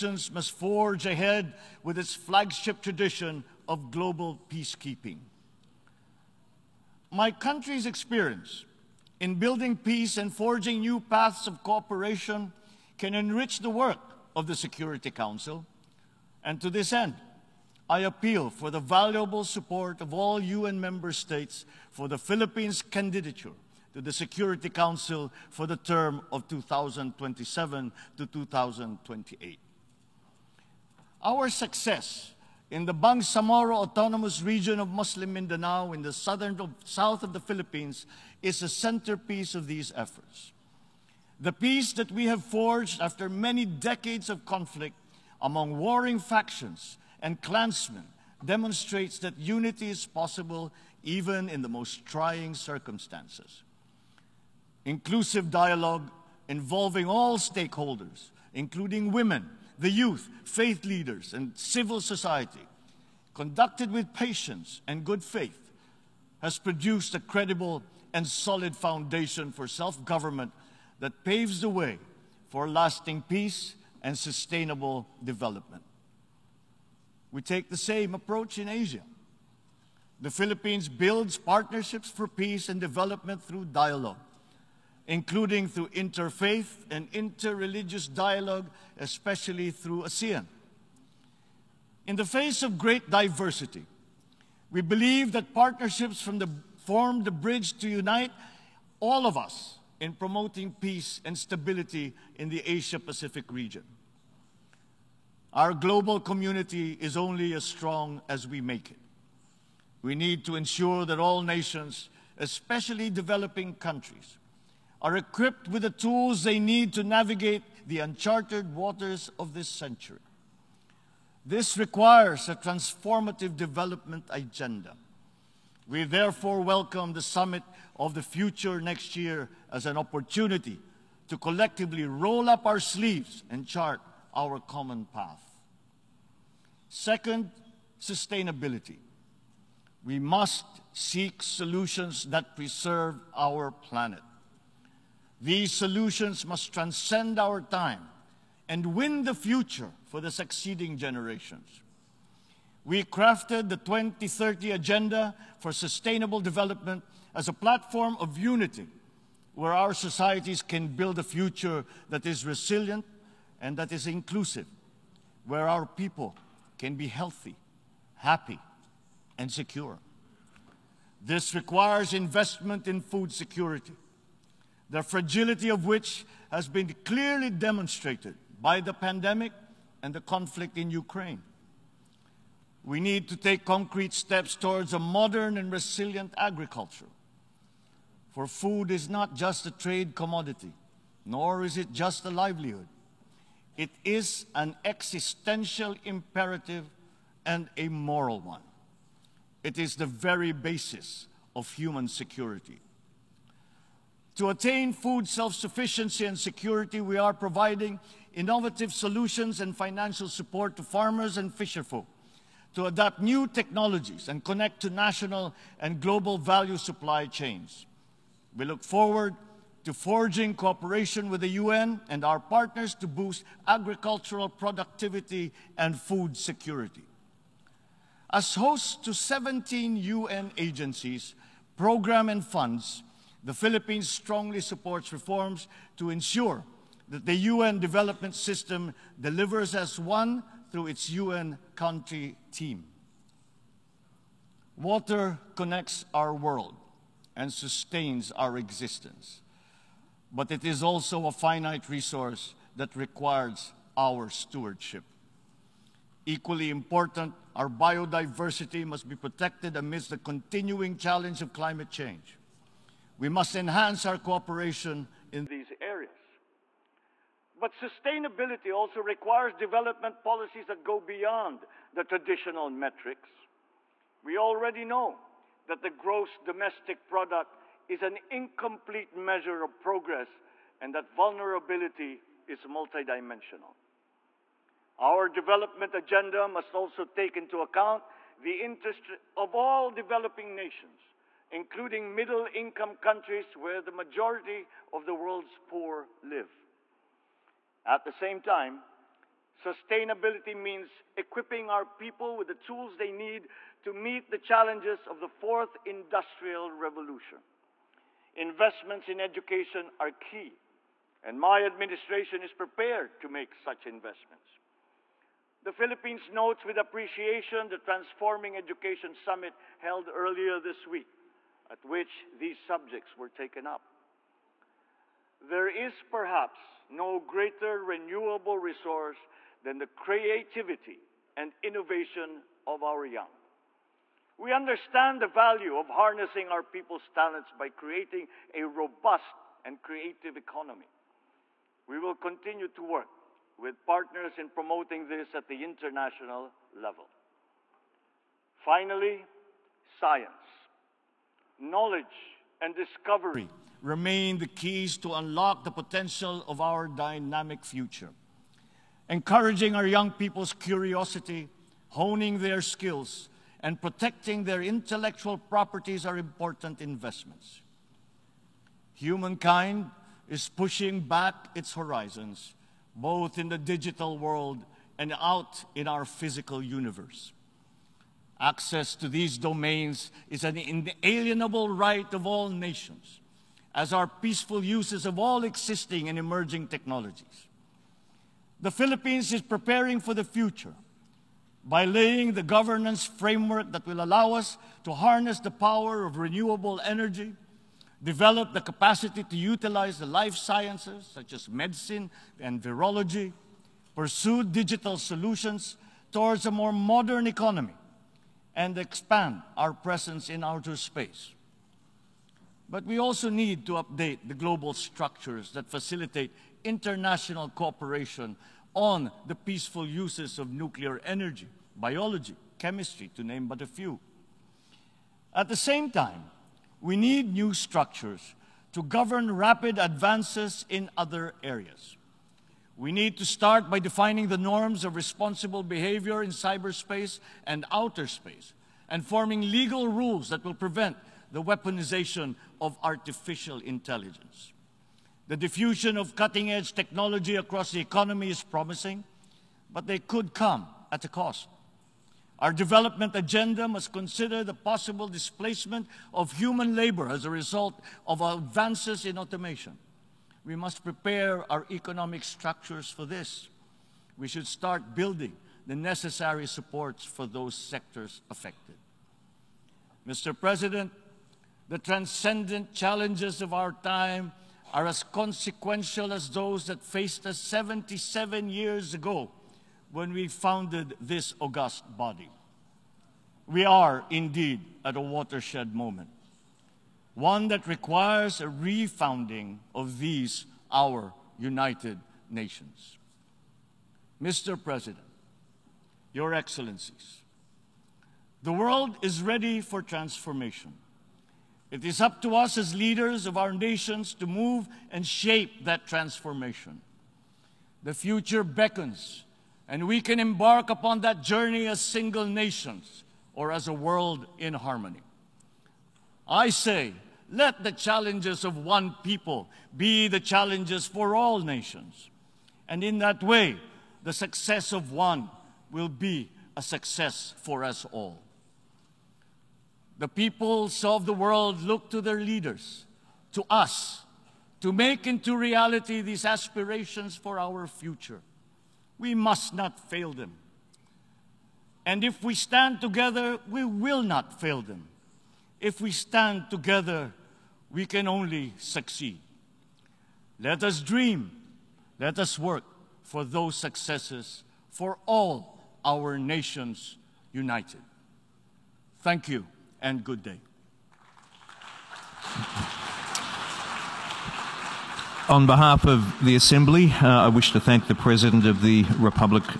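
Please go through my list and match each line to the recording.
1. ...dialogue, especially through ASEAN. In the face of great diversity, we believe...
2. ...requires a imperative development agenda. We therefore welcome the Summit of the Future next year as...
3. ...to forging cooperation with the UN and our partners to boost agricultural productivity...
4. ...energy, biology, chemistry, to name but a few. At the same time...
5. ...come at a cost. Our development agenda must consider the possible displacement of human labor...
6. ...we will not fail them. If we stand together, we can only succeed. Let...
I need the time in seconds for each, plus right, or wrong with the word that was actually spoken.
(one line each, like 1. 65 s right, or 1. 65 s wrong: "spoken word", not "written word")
1. 88 s right
2. 121 s wrong: "transformative", not "imperative"
3. 219 s right
4. 421 s right
5. 450 s right
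6. 543 s right.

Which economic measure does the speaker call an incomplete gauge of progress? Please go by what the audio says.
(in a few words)
Gross domestic product.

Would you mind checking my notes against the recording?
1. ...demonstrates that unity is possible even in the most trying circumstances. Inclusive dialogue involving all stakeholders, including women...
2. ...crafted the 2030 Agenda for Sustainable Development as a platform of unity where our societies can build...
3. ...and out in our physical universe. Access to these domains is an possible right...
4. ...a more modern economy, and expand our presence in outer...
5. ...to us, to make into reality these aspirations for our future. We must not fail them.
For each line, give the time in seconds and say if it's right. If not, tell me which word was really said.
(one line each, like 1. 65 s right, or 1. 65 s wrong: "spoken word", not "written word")
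1. 48 s right
2. 153 s right
3. 374 s wrong: "inalienable", not "possible"
4. 406 s right
5. 533 s right.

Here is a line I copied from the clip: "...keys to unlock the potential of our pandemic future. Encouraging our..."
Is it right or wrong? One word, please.
wrong.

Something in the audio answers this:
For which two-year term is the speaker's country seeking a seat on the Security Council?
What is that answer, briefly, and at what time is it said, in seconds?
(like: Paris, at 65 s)
2027 to 2028, at 26 s.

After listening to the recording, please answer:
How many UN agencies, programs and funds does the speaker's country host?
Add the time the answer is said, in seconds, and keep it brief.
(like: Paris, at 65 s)
17, at 229 s.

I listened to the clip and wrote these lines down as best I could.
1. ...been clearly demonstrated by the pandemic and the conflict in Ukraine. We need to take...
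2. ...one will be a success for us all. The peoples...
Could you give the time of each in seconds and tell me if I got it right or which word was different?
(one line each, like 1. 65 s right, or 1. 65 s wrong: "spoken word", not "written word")
1. 176 s right
2. 524 s right.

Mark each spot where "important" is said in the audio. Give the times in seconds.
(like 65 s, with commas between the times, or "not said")
256 s, 366 s.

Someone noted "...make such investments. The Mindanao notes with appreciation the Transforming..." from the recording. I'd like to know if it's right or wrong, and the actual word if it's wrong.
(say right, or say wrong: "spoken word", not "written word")
wrong: "Philippines", not "Mindanao".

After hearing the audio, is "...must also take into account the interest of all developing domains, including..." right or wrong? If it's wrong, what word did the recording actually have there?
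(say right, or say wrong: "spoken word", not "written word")
wrong: "nations", not "domains".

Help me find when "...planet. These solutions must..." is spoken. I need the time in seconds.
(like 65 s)
143 s.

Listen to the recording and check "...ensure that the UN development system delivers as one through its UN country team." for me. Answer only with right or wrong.
right.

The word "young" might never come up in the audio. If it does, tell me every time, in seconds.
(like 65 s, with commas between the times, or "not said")
333 s, 359 s.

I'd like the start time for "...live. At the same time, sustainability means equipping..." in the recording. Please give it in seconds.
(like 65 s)
296 s.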